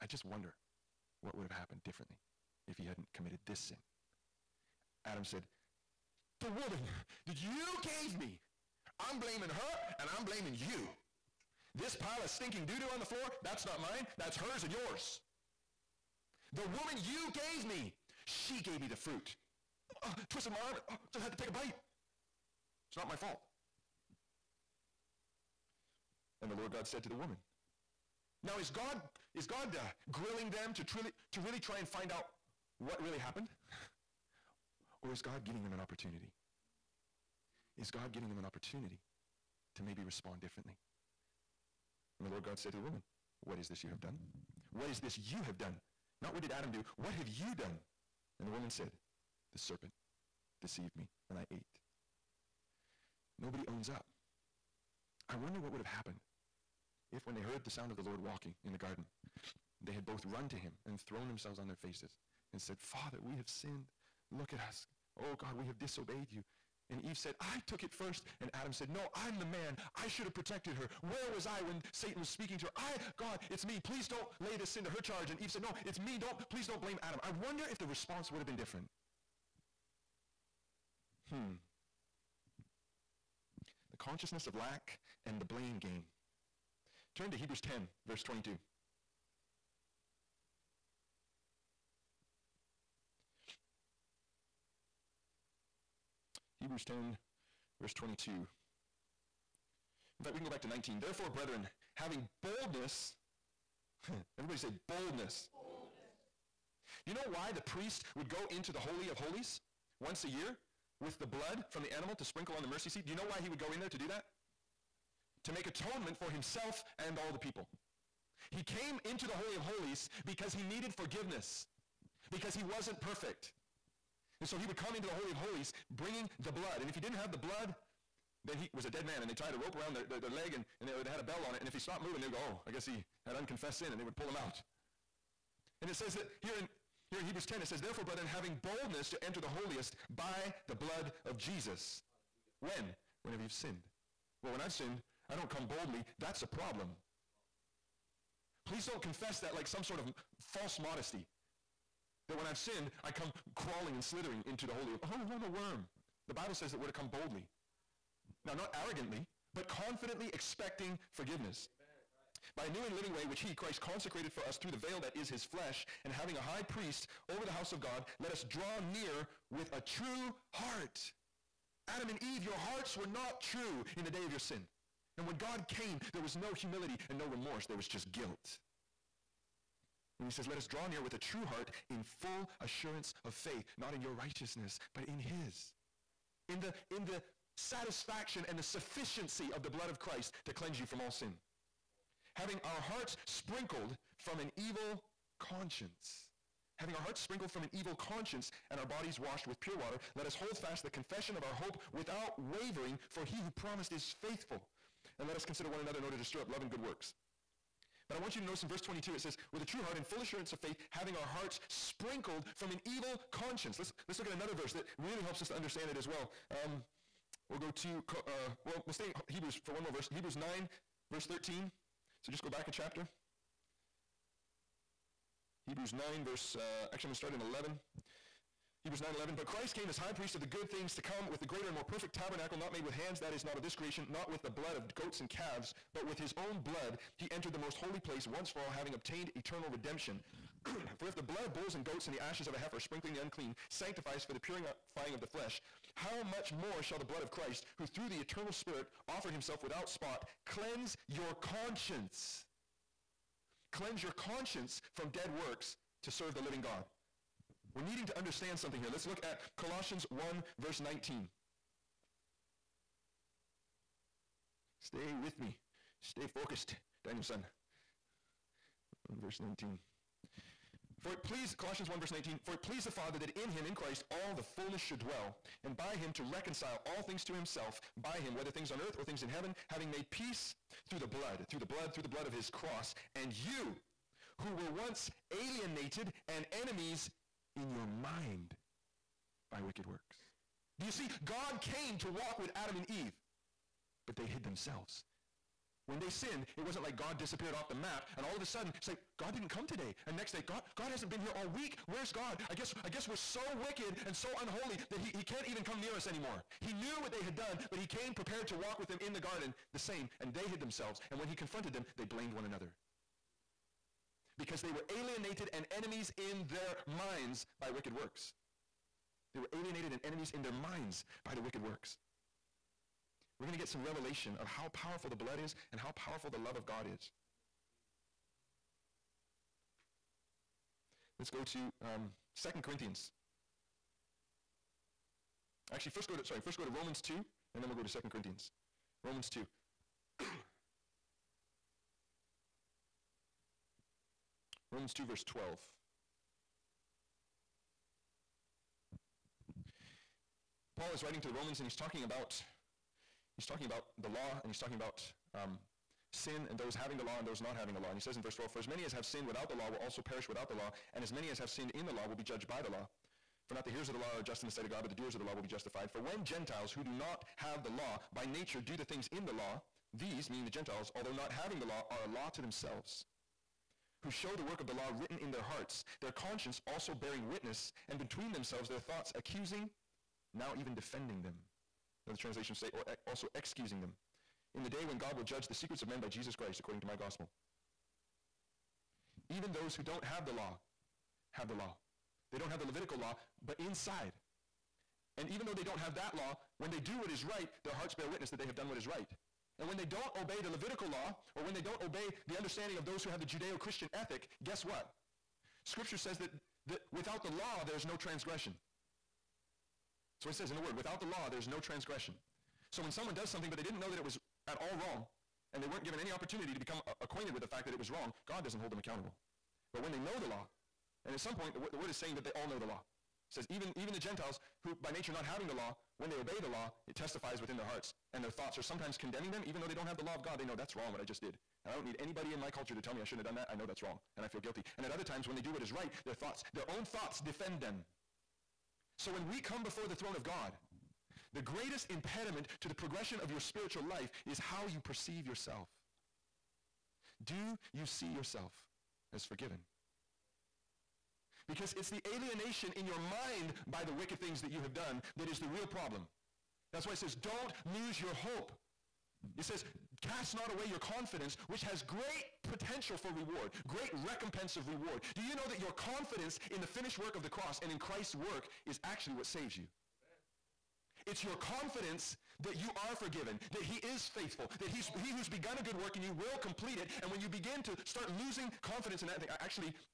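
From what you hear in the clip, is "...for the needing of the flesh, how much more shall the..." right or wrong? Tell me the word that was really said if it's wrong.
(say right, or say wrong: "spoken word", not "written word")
wrong: "purifying", not "needing".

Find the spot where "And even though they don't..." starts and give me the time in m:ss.
6:35.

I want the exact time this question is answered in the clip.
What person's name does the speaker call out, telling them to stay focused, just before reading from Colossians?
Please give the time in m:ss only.
4:27.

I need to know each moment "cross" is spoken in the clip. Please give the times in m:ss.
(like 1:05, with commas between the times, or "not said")
4:42, 7:47.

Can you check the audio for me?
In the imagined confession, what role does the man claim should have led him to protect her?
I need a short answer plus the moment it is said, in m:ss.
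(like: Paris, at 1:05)
I'm the man, at 1:09.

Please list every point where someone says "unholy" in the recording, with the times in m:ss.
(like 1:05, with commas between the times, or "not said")
5:04.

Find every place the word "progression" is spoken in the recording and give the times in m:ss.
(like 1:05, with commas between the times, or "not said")
7:22.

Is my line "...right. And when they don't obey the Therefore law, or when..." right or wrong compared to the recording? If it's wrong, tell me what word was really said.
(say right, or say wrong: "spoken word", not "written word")
wrong: "Levitical", not "Therefore".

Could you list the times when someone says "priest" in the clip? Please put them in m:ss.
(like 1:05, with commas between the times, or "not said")
1:47, 2:46, 3:50.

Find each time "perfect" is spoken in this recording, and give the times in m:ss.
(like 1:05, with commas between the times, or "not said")
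2:03, 3:51.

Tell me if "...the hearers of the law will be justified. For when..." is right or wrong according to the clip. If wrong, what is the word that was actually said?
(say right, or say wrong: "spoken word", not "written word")
wrong: "doers", not "hearers".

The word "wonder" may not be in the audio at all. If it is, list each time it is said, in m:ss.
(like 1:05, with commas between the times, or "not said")
0:00, 0:55, 1:17.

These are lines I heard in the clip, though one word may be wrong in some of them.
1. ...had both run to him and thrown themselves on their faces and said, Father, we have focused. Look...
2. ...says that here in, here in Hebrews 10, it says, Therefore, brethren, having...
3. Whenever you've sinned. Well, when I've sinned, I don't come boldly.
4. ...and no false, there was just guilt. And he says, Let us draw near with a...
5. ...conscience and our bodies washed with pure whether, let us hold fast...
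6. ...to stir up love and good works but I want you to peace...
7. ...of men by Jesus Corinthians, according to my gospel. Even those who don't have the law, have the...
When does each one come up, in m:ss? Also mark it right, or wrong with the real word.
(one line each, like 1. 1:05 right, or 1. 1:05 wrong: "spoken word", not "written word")
1. 0:59 wrong: "sinned", not "focused"
2. 2:15 right
3. 2:23 right
4. 2:57 wrong: "remorse", not "false"
5. 3:18 wrong: "water", not "whether"
6. 3:26 wrong: "notice", not "peace"
7. 6:25 wrong: "Christ", not "Corinthians".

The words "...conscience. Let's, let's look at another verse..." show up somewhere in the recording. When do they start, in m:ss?
3:33.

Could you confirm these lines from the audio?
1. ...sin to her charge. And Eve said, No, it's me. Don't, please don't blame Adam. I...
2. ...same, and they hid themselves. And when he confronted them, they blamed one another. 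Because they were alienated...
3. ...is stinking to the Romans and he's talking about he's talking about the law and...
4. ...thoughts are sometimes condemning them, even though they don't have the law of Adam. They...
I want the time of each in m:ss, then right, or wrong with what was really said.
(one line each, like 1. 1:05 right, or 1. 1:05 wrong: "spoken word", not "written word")
1. 1:14 right
2. 5:09 right
3. 5:50 wrong: "writing", not "stinking"
4. 7:08 wrong: "God", not "Adam".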